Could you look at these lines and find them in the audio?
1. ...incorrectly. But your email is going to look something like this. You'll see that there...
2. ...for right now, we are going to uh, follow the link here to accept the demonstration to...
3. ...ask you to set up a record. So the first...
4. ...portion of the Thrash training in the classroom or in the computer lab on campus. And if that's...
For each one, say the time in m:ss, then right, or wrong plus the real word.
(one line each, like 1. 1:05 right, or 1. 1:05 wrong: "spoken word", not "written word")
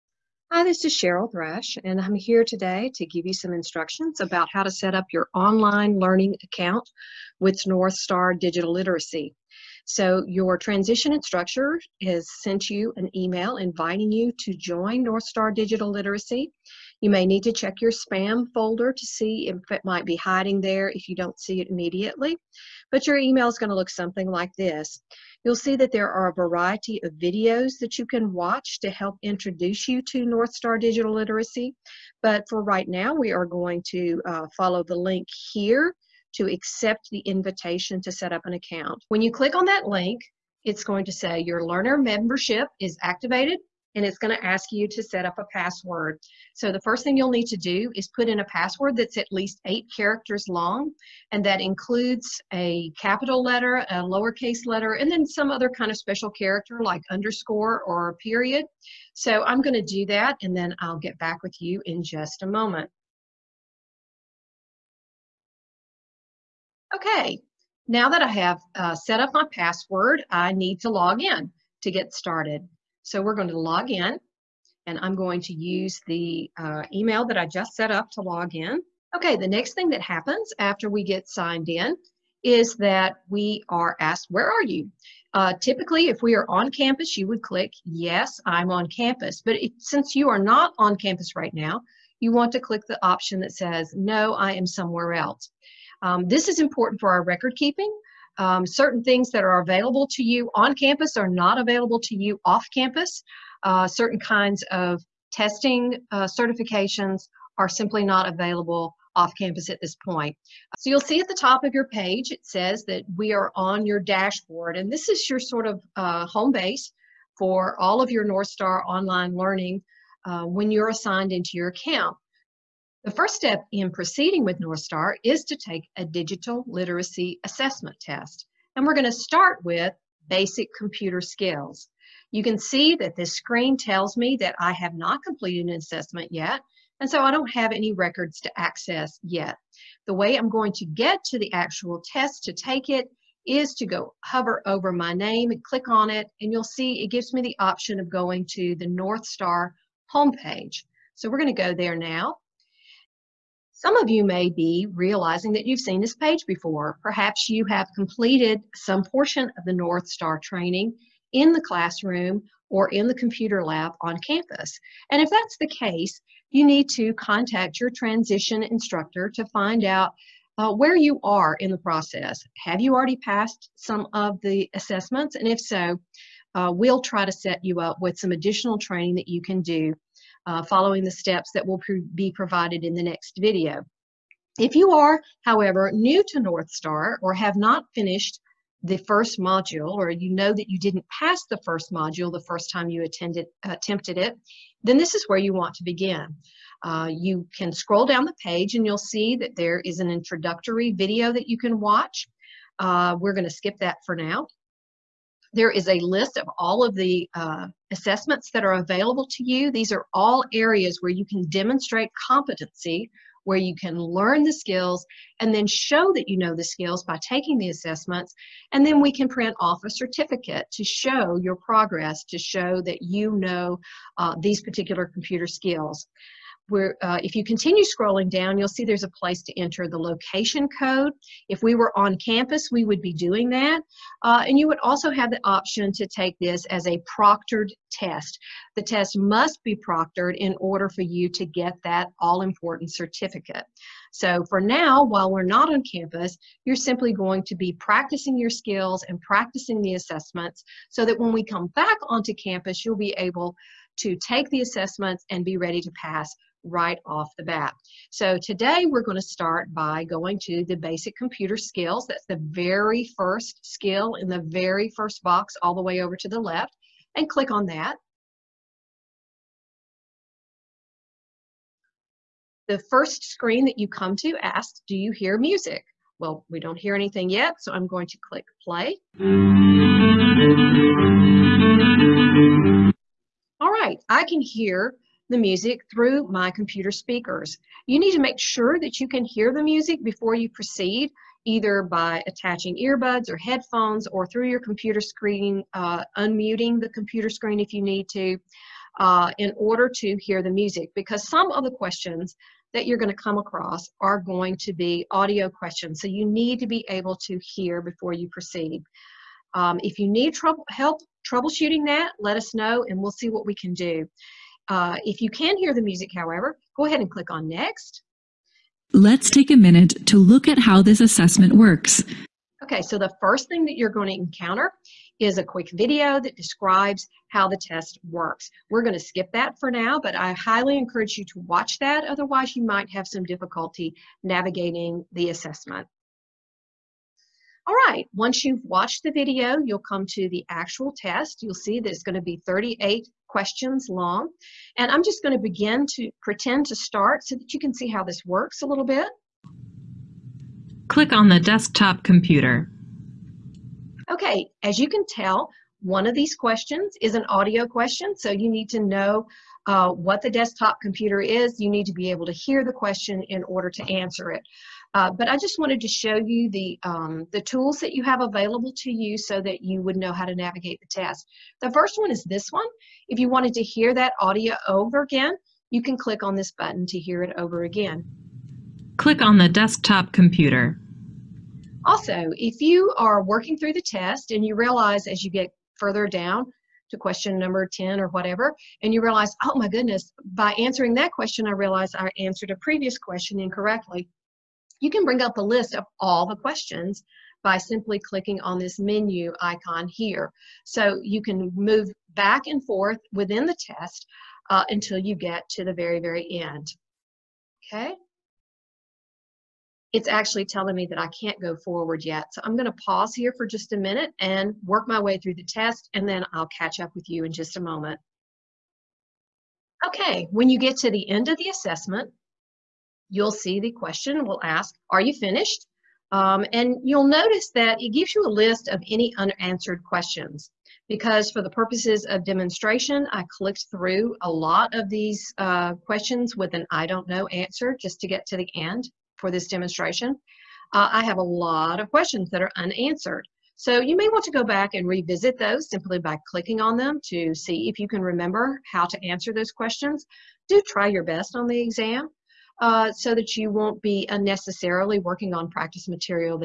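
1. 0:21 wrong: "immediately", not "incorrectly"
2. 0:32 wrong: "invitation", not "demonstration"
3. 0:44 wrong: "password", not "record"
4. 2:39 wrong: "Northstar", not "Thrash".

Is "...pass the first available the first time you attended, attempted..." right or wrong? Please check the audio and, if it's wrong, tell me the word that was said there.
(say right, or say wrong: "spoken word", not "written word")
wrong: "module", not "available".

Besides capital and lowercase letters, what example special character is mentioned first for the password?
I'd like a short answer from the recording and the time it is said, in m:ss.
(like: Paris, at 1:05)
underscore, at 0:57.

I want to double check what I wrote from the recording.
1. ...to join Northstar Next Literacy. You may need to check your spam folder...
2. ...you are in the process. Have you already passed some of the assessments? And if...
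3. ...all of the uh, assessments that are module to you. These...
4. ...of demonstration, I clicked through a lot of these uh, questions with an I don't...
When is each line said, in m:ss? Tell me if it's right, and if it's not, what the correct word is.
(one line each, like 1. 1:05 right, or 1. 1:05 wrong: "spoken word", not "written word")
1. 0:14 wrong: "Digital", not "Next"
2. 2:50 right
3. 3:26 wrong: "available", not "module"
4. 7:12 right.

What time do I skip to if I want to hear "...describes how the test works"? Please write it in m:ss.
5:26.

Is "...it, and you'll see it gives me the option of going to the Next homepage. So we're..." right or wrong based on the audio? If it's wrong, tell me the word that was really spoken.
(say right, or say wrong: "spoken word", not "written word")
wrong: "Northstar", not "Next".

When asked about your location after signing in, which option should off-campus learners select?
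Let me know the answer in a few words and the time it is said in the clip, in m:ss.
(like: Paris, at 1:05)
No, I am somewhere else, at 1:33.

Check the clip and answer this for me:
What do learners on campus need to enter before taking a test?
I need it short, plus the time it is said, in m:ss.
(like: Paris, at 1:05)
location code, at 3:49.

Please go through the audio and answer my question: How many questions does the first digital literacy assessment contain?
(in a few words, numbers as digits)
38.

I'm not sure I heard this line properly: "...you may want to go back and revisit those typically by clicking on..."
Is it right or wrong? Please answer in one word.
wrong.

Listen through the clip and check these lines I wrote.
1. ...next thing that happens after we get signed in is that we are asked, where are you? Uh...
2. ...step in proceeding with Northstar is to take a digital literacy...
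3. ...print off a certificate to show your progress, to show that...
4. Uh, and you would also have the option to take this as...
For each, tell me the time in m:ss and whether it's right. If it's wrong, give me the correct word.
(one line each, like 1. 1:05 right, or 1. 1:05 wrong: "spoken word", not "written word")
1. 1:19 right
2. 2:03 right
3. 3:39 right
4. 3:54 right.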